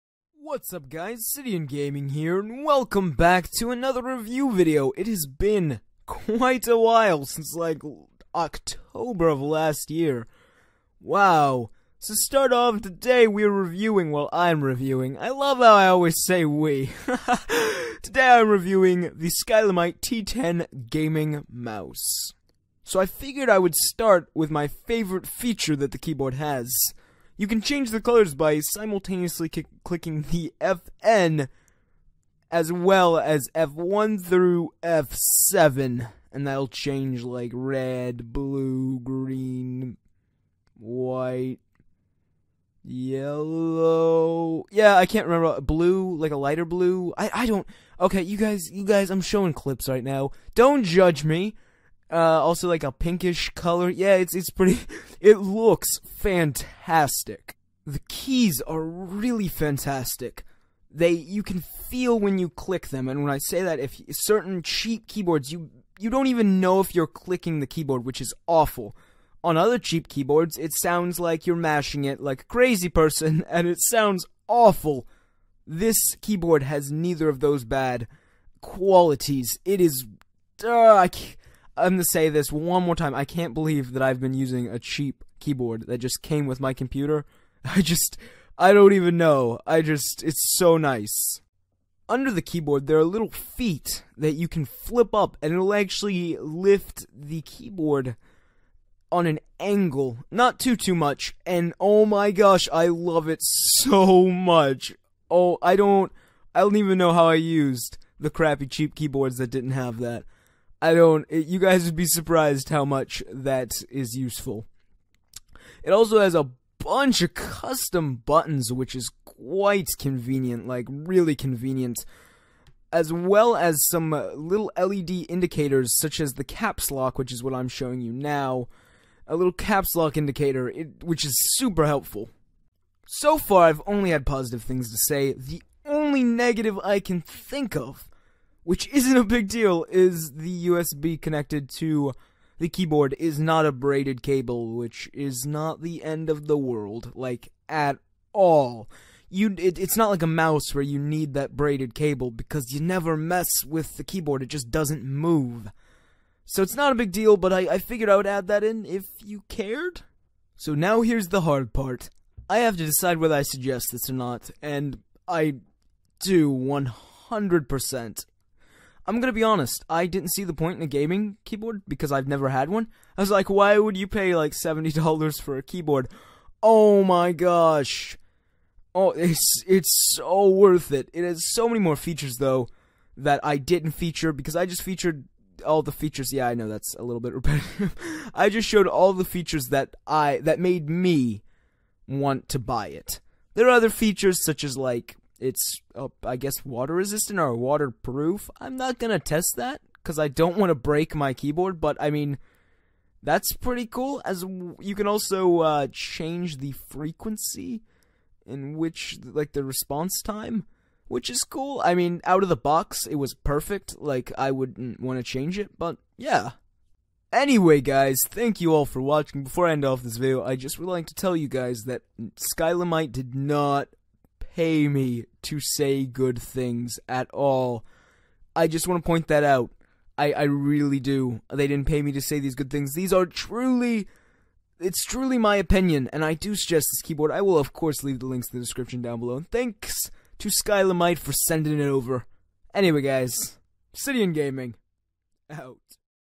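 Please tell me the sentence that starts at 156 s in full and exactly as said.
So it's not a big deal, but I, I figured I would add that in if you cared.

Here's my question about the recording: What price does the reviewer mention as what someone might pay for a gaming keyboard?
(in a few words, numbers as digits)
$70.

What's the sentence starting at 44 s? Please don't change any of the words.
Yeah, I can't remember blue, like a lighter blue.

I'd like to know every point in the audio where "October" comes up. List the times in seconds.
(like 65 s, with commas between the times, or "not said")
8 s.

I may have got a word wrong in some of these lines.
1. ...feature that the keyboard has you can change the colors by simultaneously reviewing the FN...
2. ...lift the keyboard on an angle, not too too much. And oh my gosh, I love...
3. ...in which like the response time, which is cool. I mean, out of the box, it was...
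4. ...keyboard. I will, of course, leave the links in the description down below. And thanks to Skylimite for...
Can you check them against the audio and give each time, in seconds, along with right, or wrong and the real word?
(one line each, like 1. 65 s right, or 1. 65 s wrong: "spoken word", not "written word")
1. 25 s wrong: "clicking", not "reviewing"
2. 96 s right
3. 208 s right
4. 237 s right.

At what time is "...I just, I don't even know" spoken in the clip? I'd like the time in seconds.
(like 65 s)
87 s.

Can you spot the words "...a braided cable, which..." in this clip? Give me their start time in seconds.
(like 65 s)
143 s.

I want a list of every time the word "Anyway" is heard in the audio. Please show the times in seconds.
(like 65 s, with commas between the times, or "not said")
217 s, 242 s.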